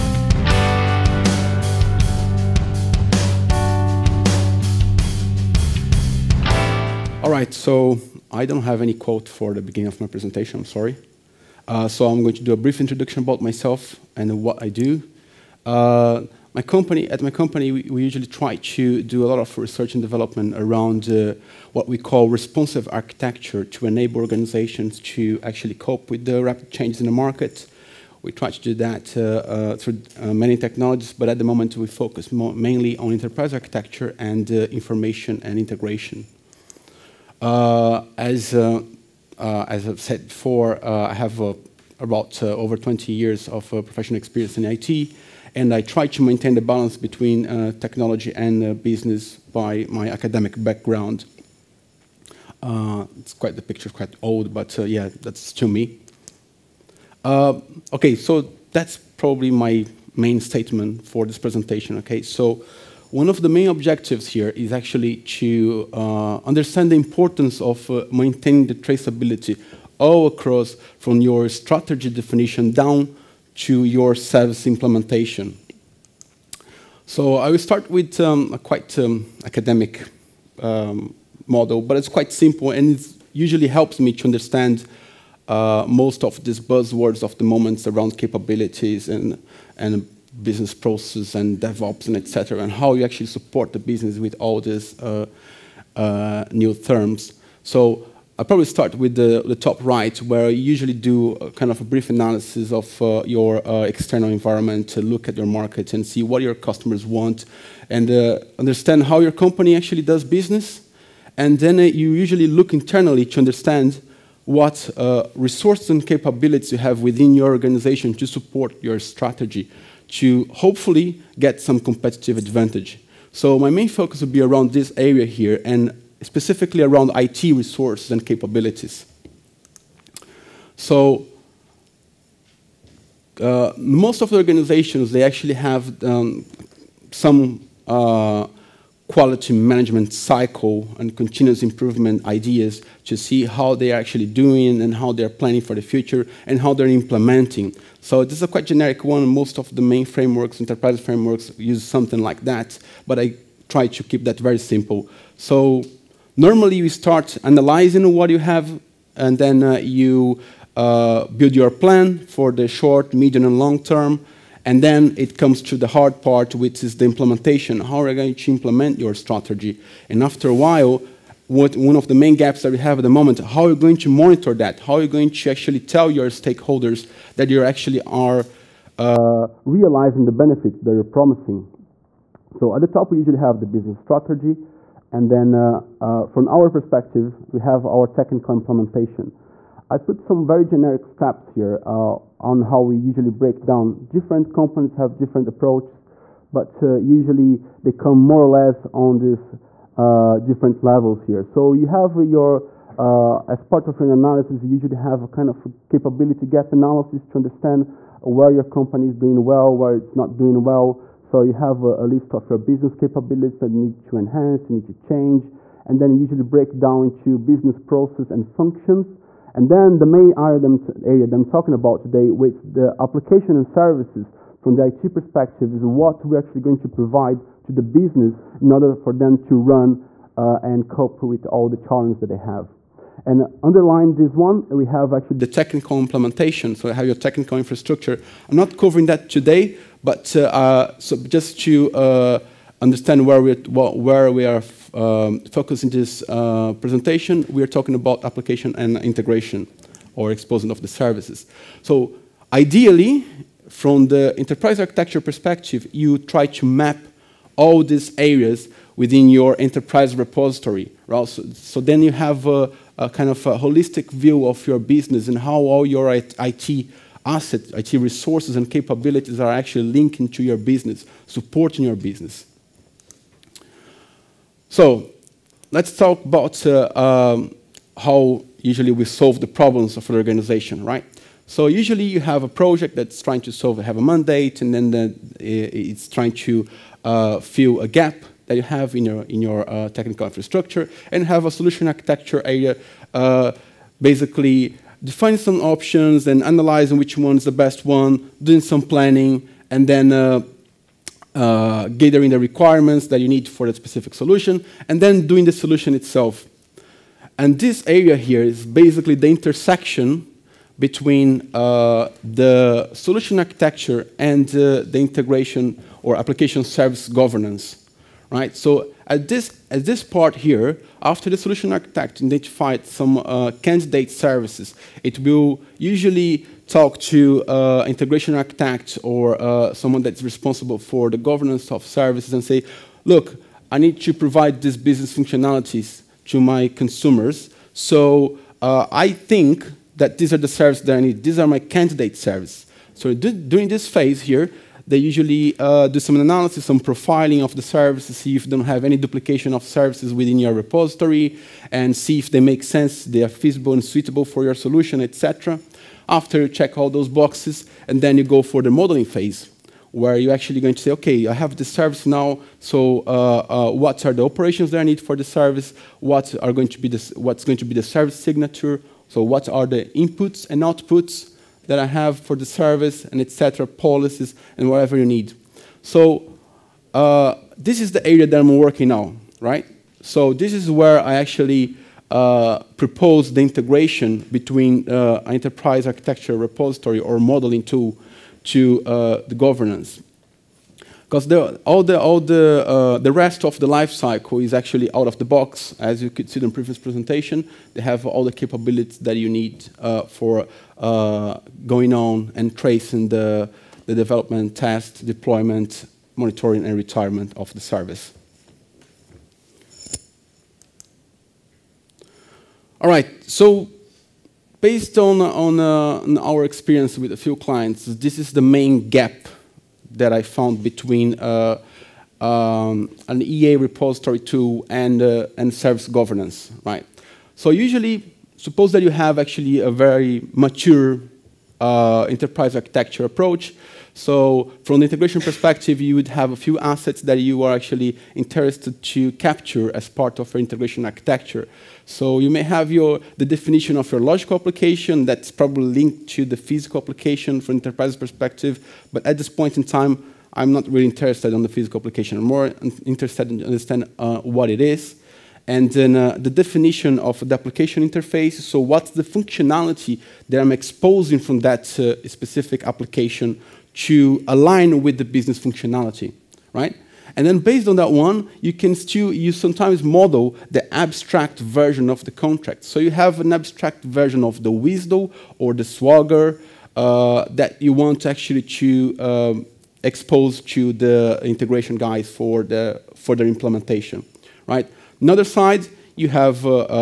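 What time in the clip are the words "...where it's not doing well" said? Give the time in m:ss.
3:29.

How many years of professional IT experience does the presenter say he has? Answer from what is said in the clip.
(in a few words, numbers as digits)
over 20 years.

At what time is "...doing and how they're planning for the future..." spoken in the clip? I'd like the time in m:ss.
2:24.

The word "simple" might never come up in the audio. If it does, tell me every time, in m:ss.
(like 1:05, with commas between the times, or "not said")
1:22, 2:34.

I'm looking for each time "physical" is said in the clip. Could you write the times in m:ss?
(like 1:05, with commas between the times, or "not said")
7:26, 7:31.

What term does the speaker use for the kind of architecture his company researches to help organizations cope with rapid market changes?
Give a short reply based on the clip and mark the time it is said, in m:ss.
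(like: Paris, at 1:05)
responsive architecture, at 0:22.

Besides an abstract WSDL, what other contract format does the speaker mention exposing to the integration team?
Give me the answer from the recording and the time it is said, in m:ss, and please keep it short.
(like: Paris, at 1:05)
Swagger, at 7:55.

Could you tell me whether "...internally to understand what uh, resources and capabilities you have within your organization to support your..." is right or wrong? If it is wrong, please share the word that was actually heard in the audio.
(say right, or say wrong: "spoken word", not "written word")
right.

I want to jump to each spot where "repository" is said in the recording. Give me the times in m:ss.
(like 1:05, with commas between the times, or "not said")
4:20, 5:50, 6:26, 7:03.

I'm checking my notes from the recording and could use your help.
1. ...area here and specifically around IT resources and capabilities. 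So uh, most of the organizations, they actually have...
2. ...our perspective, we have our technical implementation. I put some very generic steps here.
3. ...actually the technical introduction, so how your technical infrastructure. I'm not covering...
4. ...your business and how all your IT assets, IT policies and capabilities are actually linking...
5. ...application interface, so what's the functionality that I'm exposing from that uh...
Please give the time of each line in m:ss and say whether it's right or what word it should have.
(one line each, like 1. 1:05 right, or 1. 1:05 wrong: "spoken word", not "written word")
1. 2:04 right
2. 3:06 right
3. 3:55 wrong: "implementation", not "introduction"
4. 4:24 wrong: "resources", not "policies"
5. 7:37 right.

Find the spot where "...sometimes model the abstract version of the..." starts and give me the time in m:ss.
7:49.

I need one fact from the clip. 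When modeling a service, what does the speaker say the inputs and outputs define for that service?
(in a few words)
service signature.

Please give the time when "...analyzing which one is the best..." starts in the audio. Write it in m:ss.
4:56.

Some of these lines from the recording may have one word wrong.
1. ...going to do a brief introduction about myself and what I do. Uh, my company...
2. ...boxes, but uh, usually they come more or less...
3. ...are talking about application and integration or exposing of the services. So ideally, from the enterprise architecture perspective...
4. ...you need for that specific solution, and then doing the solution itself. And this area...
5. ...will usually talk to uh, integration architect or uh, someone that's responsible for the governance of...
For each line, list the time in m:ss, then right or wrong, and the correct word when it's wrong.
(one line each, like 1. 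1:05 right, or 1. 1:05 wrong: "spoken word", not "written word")
1. 0:12 right
2. 3:15 wrong: "approaches", not "boxes"
3. 4:07 right
4. 5:03 right
5. 5:25 right.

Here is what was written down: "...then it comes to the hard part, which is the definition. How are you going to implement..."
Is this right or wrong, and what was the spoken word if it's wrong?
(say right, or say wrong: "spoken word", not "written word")
wrong: "implementation", not "definition".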